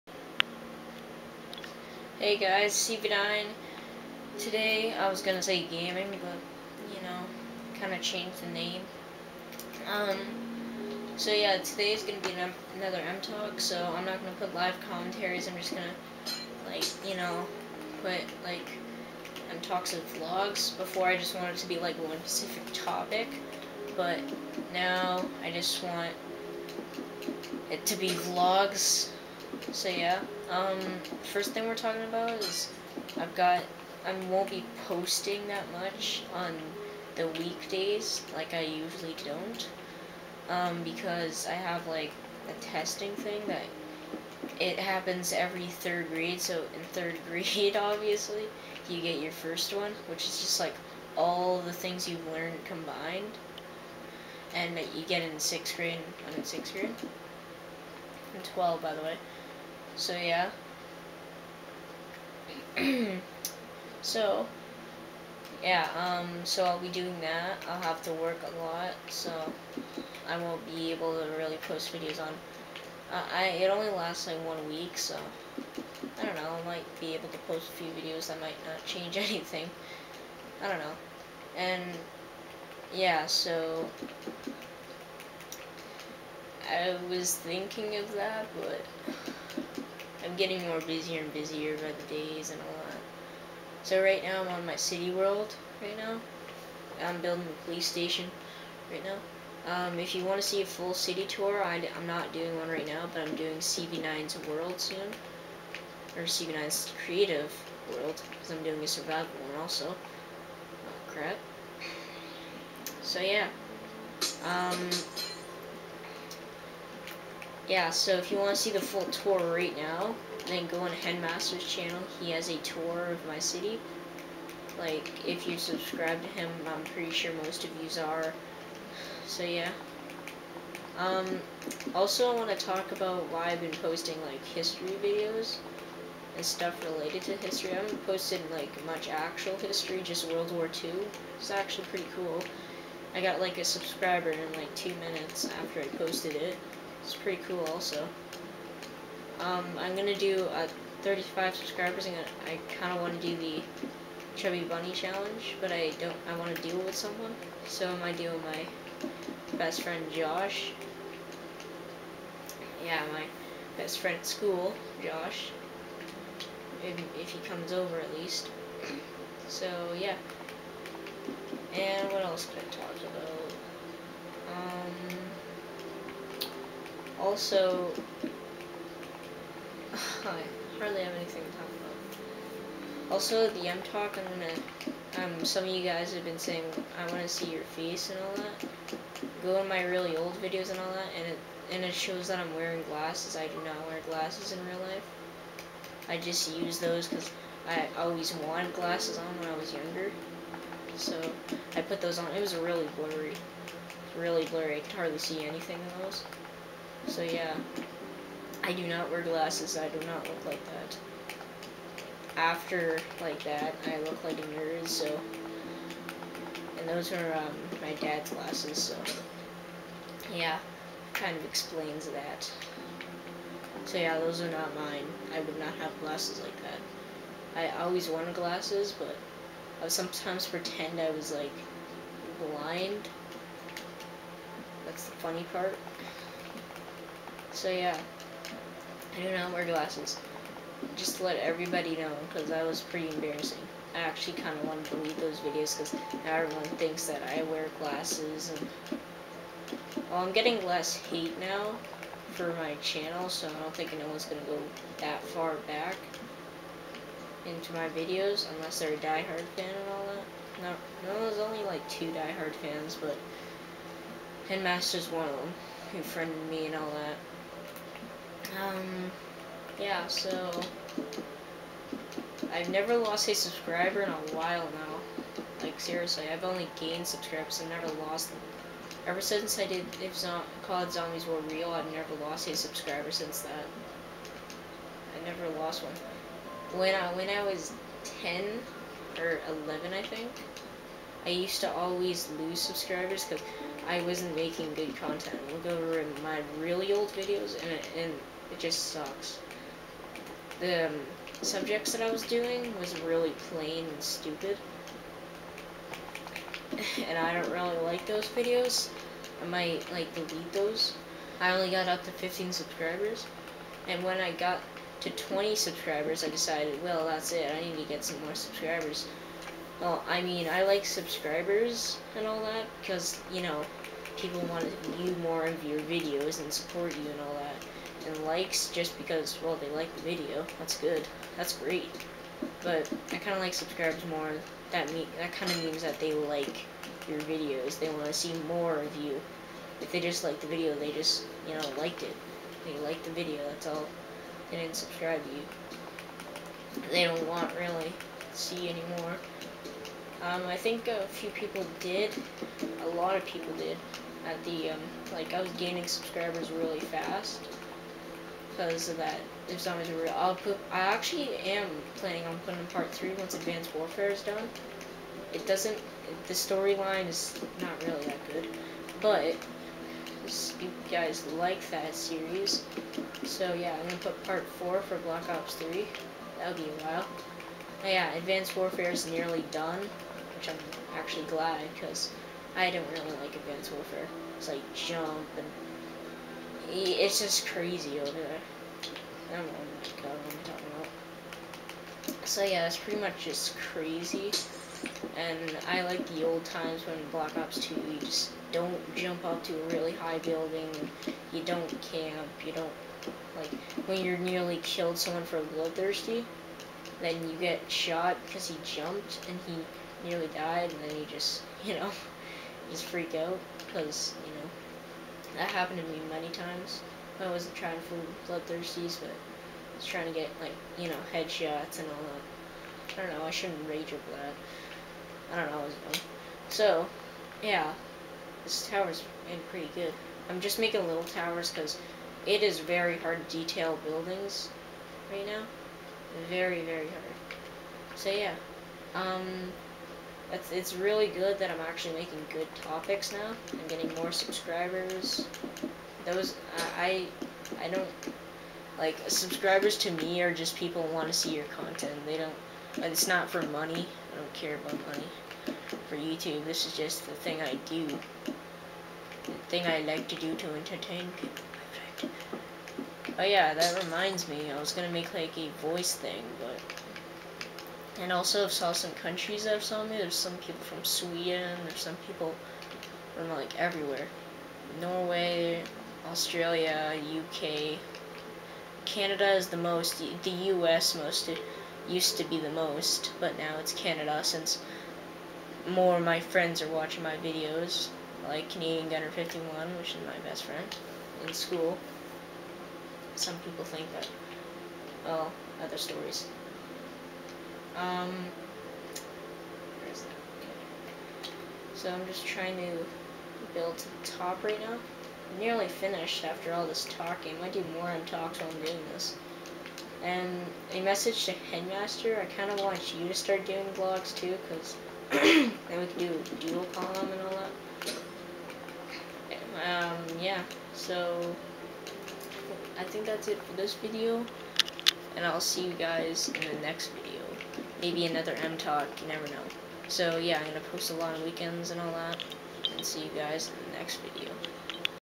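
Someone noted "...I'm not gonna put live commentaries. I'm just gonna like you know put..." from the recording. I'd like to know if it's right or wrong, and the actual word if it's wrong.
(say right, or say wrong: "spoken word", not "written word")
right.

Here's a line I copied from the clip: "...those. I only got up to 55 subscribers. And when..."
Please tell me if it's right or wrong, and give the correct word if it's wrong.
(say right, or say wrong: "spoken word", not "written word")
wrong: "15", not "55".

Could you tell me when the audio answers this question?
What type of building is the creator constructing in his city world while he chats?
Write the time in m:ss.
1:37.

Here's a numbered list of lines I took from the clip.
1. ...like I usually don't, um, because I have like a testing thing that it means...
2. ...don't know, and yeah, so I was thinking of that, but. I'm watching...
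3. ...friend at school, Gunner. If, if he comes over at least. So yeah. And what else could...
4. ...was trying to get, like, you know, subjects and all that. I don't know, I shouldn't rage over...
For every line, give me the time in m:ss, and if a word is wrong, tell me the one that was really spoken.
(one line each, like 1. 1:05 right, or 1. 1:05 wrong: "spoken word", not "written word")
1. 0:38 wrong: "happens", not "means"
2. 1:20 wrong: "getting", not "watching"
3. 2:43 wrong: "Josh", not "Gunner"
4. 6:59 wrong: "headshots", not "subjects".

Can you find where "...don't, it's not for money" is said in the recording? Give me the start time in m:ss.
7:32.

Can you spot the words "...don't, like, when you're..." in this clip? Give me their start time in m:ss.
6:42.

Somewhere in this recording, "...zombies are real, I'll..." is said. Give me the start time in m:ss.
5:59.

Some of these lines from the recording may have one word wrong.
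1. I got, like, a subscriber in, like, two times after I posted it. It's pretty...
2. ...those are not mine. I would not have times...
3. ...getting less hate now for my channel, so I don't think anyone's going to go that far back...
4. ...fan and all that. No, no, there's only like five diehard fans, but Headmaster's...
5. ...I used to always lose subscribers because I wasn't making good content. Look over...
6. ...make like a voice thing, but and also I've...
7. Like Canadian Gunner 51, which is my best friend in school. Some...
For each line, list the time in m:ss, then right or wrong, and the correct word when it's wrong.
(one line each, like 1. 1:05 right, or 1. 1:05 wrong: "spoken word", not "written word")
1. 2:23 wrong: "minutes", not "times"
2. 3:44 wrong: "glasses", not "times"
3. 4:10 right
4. 4:19 wrong: "two", not "five"
5. 4:51 right
6. 7:44 right
7. 8:08 right.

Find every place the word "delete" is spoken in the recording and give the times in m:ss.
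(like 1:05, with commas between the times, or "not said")
4:04, 5:10.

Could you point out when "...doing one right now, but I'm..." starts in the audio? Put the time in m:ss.
1:42.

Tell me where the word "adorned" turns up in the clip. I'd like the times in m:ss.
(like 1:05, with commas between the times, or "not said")
not said.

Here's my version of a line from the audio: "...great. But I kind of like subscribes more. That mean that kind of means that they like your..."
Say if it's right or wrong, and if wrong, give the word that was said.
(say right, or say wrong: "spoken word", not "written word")
right.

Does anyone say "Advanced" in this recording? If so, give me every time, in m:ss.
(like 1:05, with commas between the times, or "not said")
6:03, 6:18, 6:23.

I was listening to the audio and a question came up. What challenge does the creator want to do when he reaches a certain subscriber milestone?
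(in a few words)
Chubby Bunny challenge.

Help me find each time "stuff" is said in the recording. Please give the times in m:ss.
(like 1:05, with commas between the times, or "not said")
2:16.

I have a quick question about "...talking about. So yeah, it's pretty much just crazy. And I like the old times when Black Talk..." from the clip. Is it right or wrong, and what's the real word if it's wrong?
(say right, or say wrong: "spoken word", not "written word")
wrong: "Ops", not "Talk".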